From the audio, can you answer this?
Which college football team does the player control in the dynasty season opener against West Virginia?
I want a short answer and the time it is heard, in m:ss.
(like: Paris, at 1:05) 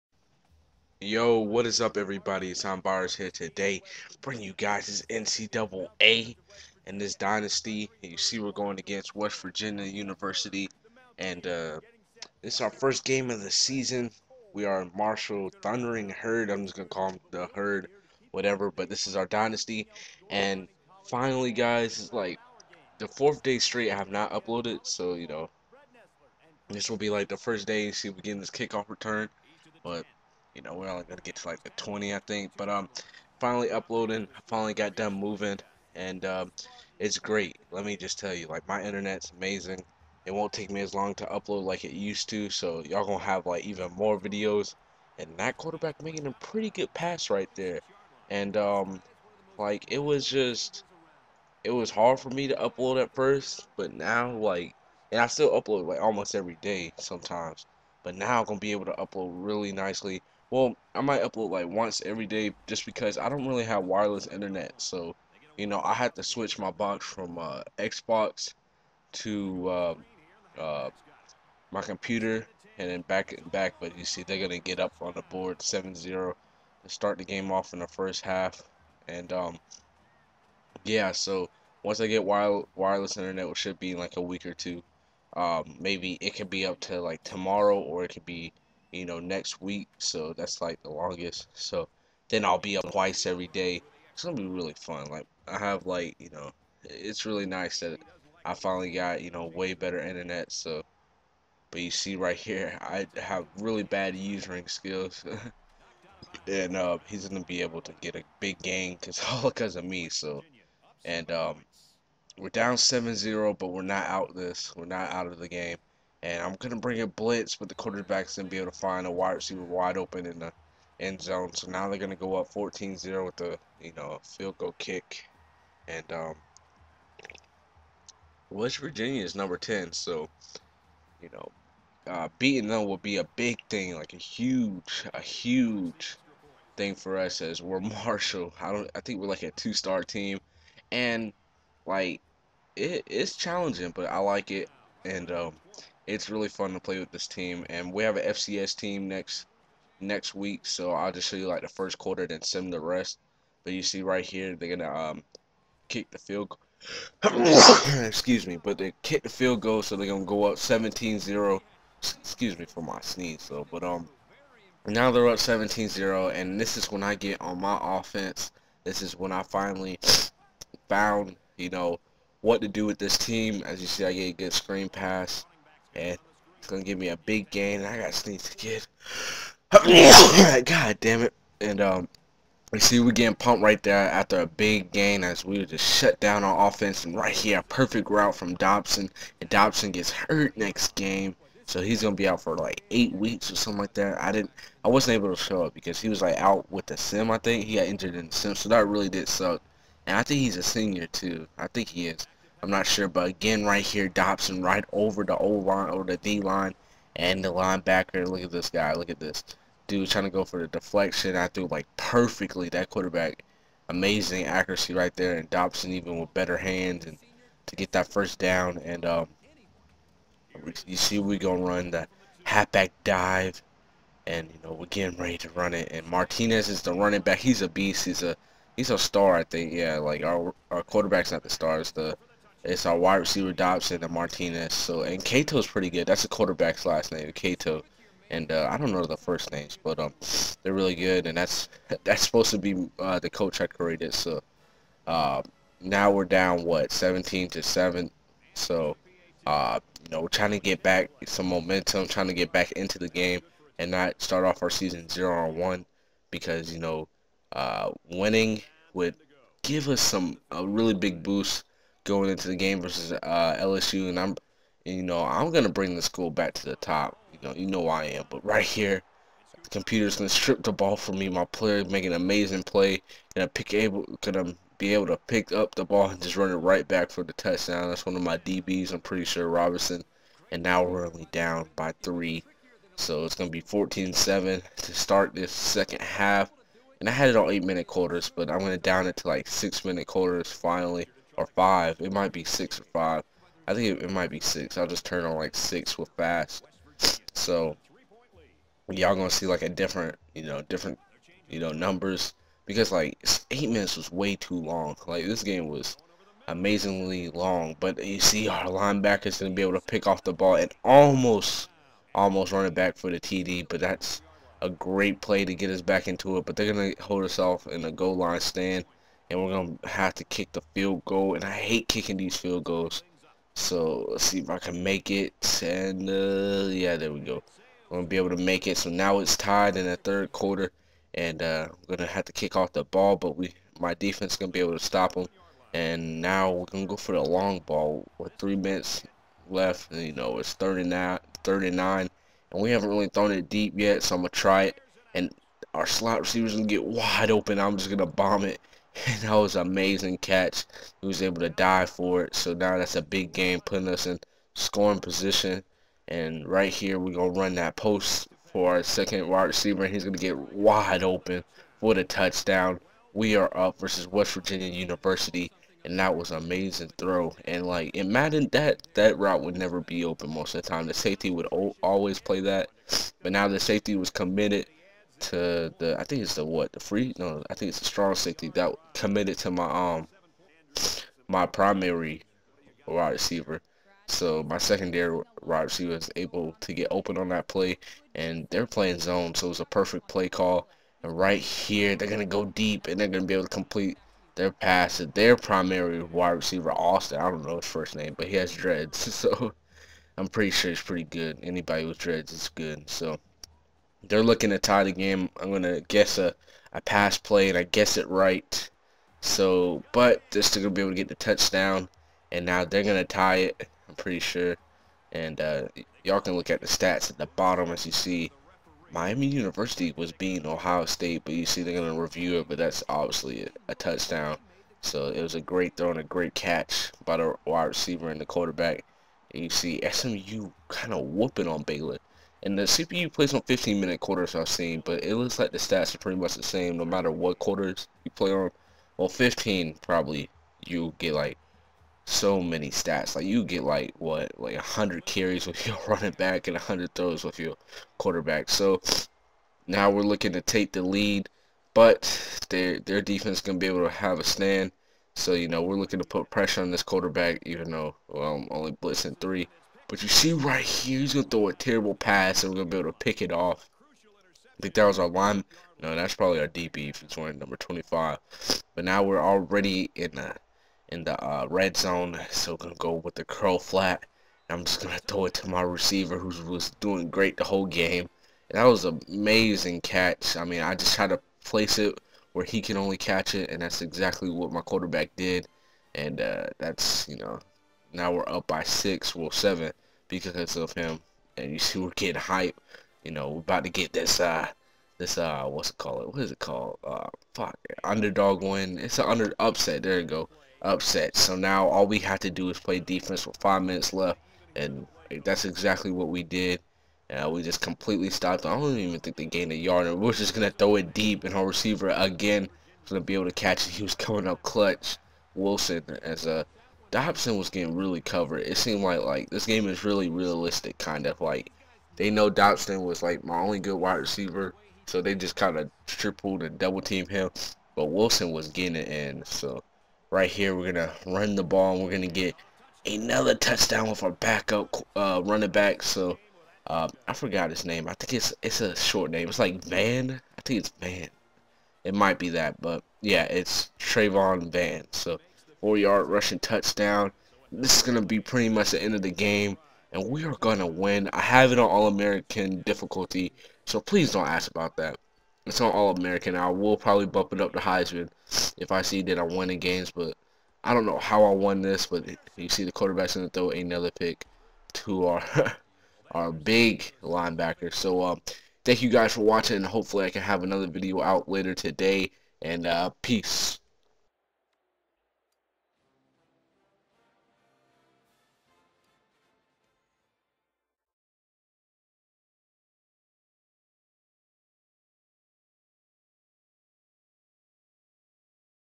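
Marshall Thundering Herd, at 0:14.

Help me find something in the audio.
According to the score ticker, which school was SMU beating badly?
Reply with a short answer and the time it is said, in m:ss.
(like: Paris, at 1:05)
Baylor, at 7:11.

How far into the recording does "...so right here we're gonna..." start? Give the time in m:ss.
8:49.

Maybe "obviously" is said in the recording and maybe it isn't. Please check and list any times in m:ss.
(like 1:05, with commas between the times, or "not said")
7:02.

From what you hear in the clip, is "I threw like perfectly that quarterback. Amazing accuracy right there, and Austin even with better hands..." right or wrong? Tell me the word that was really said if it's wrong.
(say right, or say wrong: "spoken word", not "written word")
wrong: "Dobson", not "Austin".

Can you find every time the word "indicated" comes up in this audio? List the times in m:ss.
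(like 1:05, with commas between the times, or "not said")
not said.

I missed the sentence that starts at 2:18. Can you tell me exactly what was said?
I don't, I think we're like a two-star team, and like it, it's challenging, but I like it.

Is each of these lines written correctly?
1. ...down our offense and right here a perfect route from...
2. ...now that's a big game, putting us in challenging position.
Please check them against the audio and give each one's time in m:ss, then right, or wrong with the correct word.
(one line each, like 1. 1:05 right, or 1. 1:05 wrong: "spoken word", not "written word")
1. 3:06 right
2. 5:52 wrong: "scoring", not "challenging".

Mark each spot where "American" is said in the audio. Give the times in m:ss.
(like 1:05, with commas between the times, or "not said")
9:11, 9:15.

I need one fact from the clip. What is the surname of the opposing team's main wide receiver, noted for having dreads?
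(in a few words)
Austin.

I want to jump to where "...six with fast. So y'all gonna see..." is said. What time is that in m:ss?
4:55.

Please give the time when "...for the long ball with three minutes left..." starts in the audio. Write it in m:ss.
5:36.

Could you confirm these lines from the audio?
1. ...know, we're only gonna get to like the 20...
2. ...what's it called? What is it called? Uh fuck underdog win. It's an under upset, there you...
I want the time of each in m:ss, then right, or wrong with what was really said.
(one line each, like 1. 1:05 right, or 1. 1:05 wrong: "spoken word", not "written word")
1. 0:30 right
2. 8:15 right.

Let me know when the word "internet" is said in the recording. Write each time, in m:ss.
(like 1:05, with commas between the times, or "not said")
0:38, 1:04, 1:23, 1:39.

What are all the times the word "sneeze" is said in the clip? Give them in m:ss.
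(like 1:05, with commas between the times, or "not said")
2:43, 2:58.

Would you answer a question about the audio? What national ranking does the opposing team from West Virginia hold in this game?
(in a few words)
10.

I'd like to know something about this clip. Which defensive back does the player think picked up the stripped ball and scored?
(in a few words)
Robinson.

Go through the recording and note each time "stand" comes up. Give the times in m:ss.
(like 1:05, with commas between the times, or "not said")
5:18, 7:34.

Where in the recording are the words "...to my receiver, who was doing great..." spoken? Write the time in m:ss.
7:55.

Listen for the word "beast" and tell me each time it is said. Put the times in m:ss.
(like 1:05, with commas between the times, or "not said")
3:47.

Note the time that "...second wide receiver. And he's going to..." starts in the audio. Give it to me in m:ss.
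5:58.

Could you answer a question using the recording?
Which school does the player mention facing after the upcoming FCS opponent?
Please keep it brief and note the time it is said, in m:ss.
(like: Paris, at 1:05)
LSU, at 4:23.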